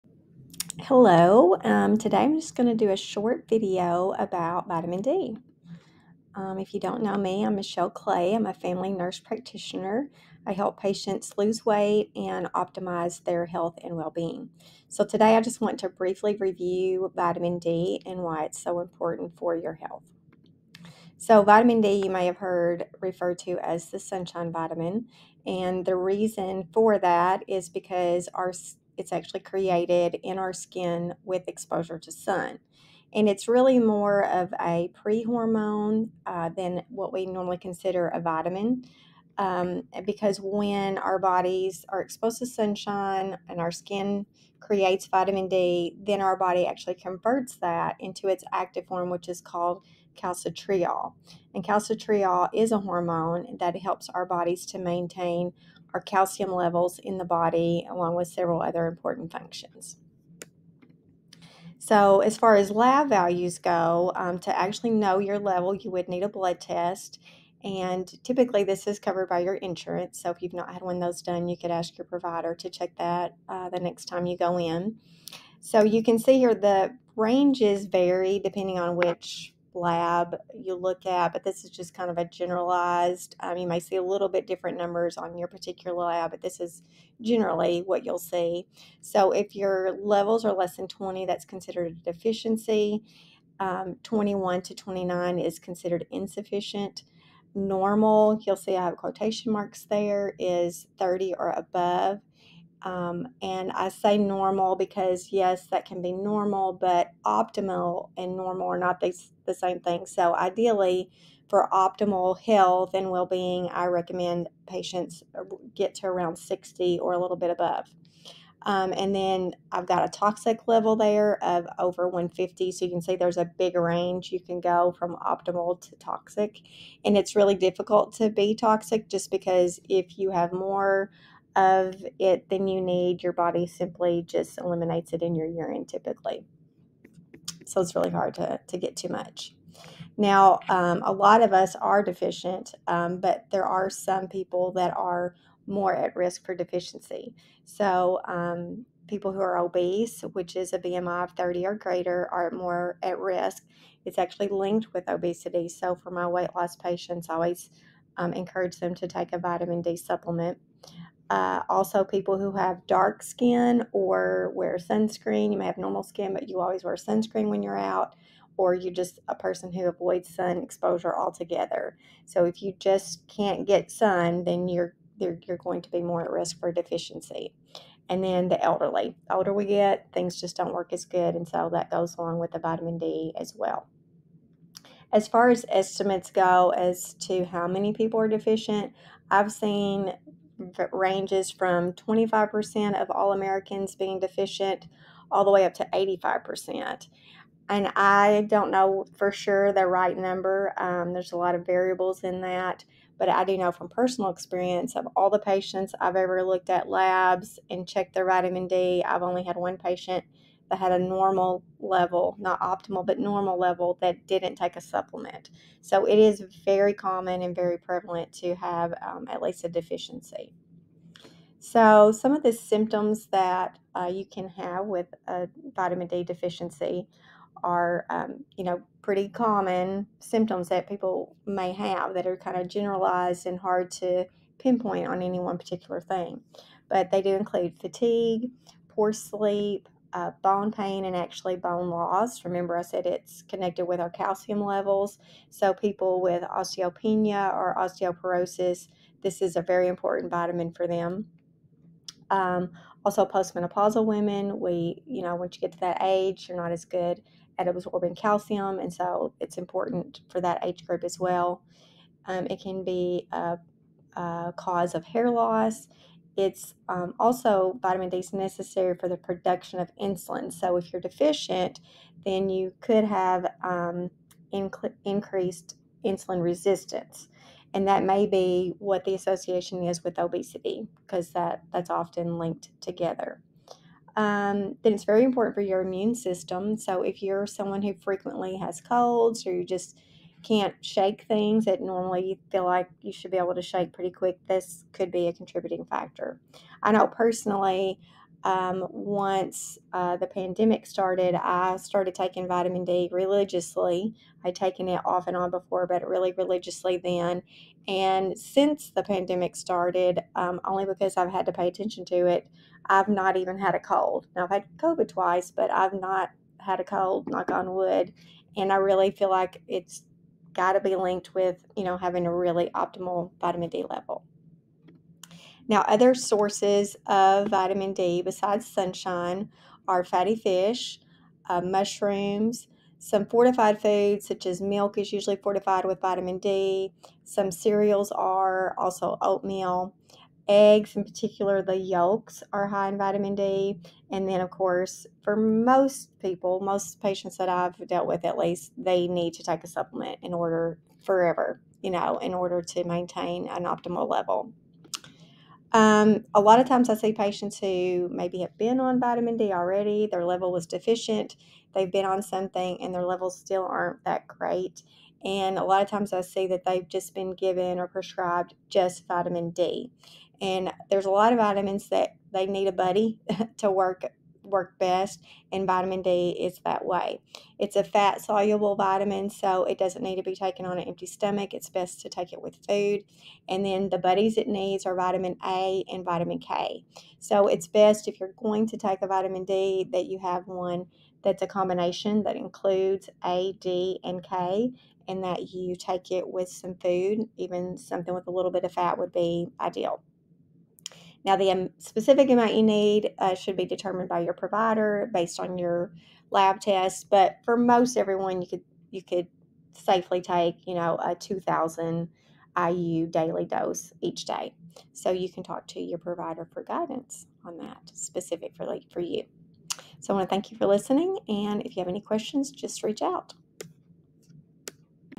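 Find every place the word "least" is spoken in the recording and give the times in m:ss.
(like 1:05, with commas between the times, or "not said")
3:39, 5:48.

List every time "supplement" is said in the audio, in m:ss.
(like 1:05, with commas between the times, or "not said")
2:39, 3:34, 5:49.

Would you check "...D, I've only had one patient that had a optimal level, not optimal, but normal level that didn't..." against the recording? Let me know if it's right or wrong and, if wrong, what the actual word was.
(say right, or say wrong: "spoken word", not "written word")
wrong: "normal", not "optimal".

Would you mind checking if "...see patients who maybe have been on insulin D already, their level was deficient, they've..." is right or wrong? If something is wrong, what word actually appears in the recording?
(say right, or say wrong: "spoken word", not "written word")
wrong: "vitamin", not "insulin".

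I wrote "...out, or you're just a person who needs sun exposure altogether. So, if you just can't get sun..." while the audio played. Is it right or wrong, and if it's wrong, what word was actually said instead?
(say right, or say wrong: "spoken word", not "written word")
wrong: "avoids", not "needs".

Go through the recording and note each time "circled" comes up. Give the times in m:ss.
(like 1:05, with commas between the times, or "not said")
not said.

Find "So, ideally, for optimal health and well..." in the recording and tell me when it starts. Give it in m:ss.
1:50.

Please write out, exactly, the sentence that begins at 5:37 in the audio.
Some cereals are also oatmeal, eggs, in particular the yolks, are high in vitamin D.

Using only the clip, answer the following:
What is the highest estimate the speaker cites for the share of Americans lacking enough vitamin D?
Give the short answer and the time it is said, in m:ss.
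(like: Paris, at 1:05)
85%, at 3:15.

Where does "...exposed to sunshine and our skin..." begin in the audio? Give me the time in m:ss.
0:42.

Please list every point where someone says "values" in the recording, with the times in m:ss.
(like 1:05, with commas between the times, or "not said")
1:03.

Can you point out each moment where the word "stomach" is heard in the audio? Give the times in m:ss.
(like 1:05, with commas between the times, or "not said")
6:21.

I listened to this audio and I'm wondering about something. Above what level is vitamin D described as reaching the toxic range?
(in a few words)
150.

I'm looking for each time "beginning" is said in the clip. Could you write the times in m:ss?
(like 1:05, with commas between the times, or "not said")
not said.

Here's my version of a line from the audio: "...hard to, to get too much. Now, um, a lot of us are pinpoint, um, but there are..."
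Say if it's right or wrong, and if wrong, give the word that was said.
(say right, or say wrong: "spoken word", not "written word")
wrong: "deficient", not "pinpoint".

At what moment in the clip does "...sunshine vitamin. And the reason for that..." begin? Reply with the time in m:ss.
0:23.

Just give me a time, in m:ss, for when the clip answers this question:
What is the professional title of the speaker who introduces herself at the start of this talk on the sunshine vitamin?
0:08.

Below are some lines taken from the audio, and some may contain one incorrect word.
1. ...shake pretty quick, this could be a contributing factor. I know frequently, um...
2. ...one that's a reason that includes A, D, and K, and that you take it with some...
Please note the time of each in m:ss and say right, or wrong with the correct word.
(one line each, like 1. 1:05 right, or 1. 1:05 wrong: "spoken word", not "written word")
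1. 4:53 wrong: "personally", not "frequently"
2. 6:30 wrong: "combination", not "reason".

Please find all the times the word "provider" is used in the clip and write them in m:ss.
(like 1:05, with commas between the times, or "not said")
1:12, 6:44, 6:55.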